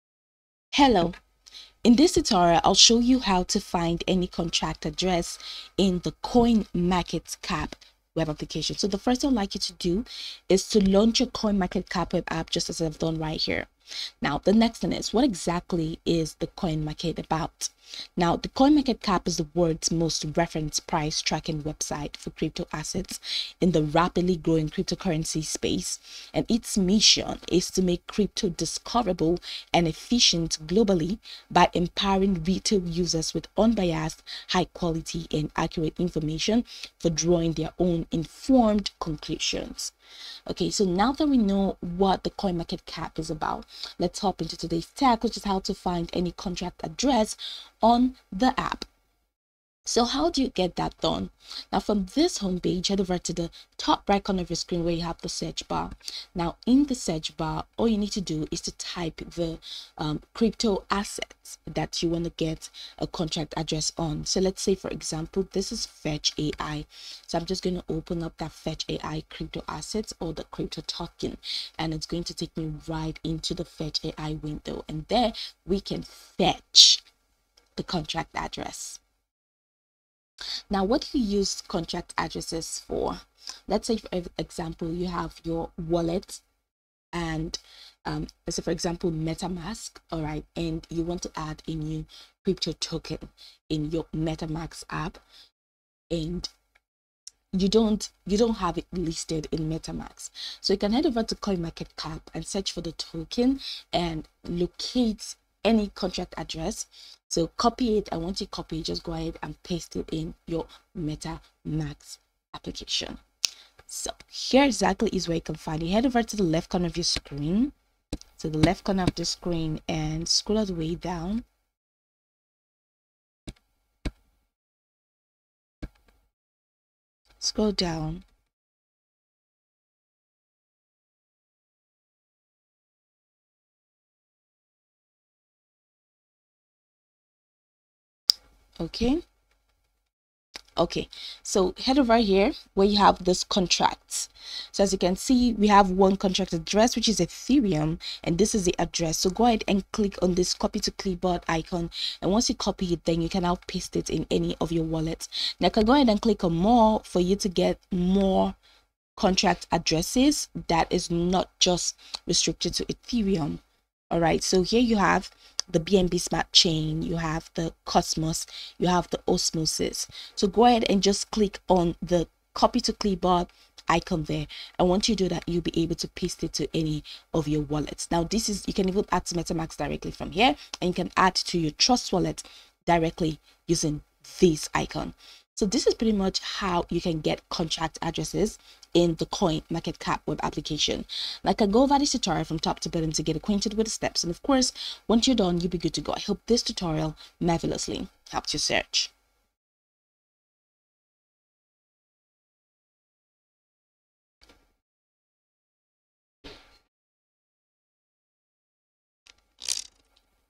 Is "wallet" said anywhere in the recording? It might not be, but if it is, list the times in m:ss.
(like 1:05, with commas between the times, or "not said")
1:25, 2:34, 2:57, 3:02.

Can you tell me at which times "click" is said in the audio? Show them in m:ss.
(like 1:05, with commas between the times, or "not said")
2:29, 2:36, 2:51.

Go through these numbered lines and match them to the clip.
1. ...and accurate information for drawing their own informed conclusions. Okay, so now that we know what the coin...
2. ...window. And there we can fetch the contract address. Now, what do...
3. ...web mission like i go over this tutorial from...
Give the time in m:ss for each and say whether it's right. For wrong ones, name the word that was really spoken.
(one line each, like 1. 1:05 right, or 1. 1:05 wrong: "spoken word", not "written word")
1. 0:35 right
2. 1:14 right
3. 3:10 wrong: "application", not "mission".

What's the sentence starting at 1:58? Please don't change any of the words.
So the left corner of the screen and scroll all the way down.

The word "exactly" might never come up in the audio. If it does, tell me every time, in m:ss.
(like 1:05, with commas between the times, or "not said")
0:15, 1:54.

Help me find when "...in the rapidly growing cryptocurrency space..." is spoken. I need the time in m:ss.
0:23.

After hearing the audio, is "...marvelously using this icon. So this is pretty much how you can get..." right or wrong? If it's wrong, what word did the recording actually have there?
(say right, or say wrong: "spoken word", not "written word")
wrong: "directly", not "marvelously".